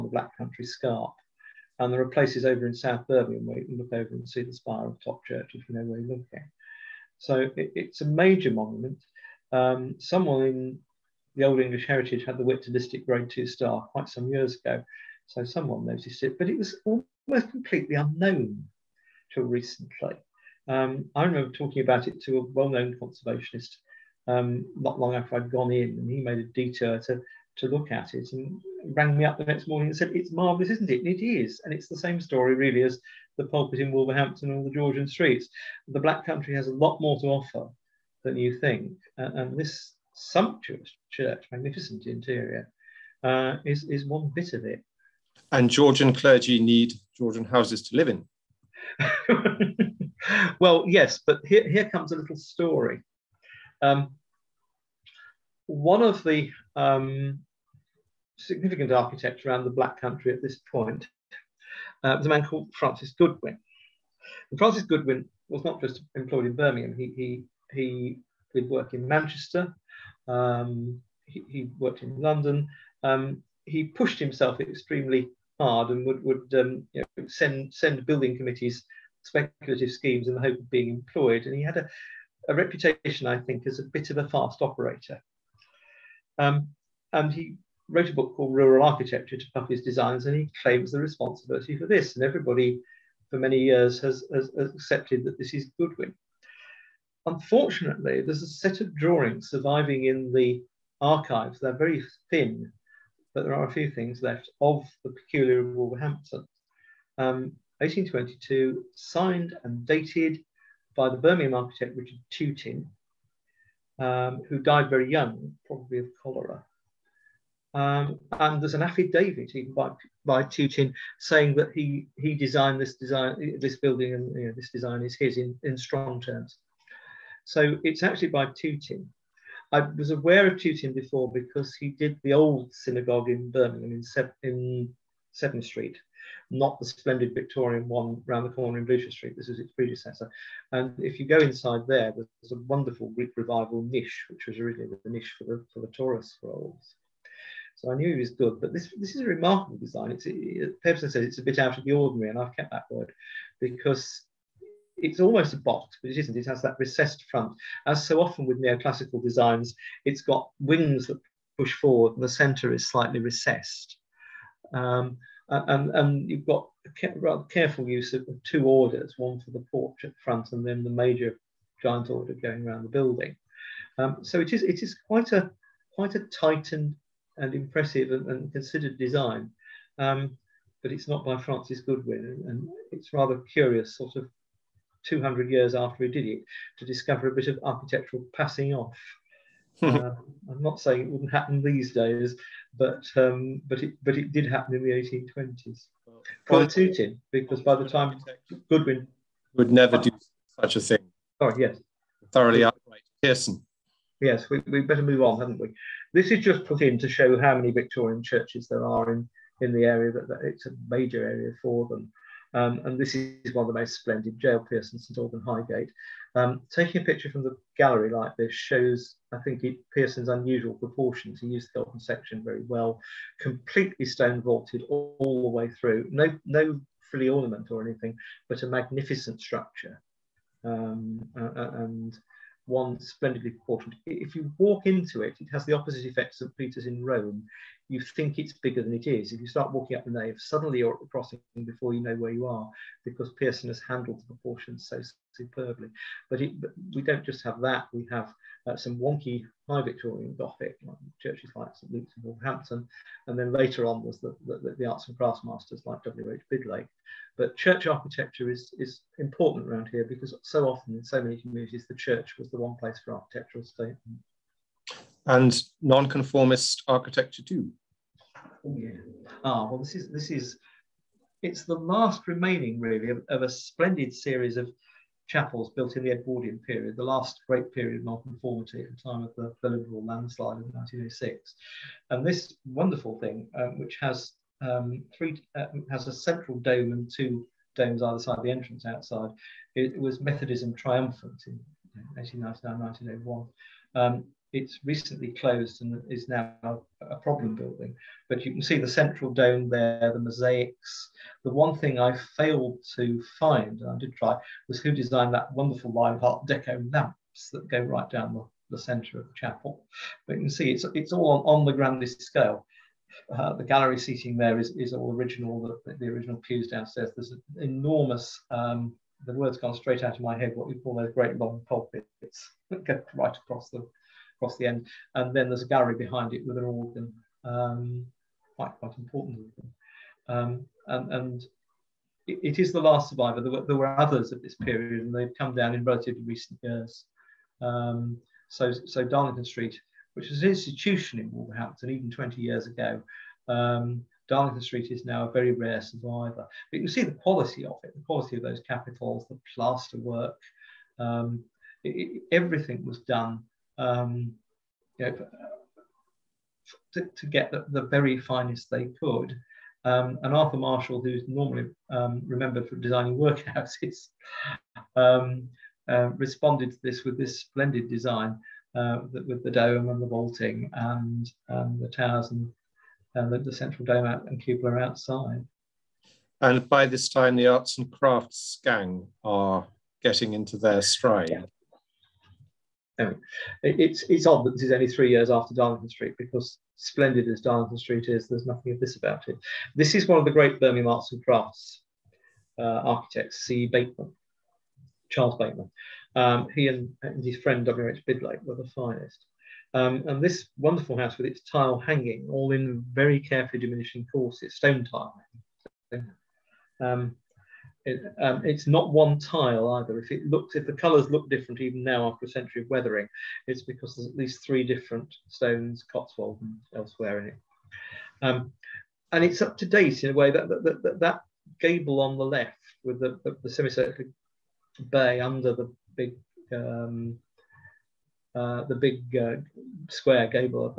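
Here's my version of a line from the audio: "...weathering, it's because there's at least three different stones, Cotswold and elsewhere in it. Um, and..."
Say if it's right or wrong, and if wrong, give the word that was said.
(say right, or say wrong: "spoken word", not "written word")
right.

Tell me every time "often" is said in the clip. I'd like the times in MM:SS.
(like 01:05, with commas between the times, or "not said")
02:38, 04:20.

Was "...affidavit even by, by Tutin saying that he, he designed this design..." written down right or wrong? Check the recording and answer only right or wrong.
right.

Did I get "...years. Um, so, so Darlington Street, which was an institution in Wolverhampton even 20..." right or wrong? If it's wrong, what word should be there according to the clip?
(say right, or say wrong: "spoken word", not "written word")
right.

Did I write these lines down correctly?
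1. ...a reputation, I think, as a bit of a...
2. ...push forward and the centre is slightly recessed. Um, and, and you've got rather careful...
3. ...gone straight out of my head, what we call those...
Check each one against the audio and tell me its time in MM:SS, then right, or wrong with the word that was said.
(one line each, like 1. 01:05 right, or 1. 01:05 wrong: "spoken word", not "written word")
1. 01:22 right
2. 02:41 right
3. 05:19 right.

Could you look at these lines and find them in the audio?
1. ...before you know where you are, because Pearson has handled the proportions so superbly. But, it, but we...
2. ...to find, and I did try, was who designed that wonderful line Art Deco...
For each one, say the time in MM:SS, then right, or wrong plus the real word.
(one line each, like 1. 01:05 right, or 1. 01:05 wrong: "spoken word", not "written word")
1. 04:01 right
2. 05:02 right.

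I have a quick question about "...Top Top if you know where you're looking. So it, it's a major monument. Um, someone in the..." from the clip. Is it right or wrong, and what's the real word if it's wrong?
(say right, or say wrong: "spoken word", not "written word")
wrong: "Church", not "Top".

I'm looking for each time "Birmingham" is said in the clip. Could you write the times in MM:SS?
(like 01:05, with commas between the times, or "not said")
00:03, 01:06, 01:51, 02:13, 06:30.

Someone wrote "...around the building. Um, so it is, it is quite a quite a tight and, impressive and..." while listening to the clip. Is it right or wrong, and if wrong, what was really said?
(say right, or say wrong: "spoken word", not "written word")
right.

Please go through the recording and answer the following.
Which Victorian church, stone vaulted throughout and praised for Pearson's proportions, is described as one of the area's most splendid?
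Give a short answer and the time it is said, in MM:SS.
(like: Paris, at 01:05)
St Alban Highgate, at 03:34.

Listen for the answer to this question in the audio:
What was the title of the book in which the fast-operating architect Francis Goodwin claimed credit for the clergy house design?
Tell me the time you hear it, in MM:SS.
01:28.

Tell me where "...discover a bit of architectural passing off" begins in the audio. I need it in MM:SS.
03:06.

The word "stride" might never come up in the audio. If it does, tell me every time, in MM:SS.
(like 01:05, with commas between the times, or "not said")
06:20.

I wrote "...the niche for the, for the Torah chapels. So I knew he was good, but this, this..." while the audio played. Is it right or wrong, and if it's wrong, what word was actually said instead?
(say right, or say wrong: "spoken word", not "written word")
wrong: "scrolls", not "chapels".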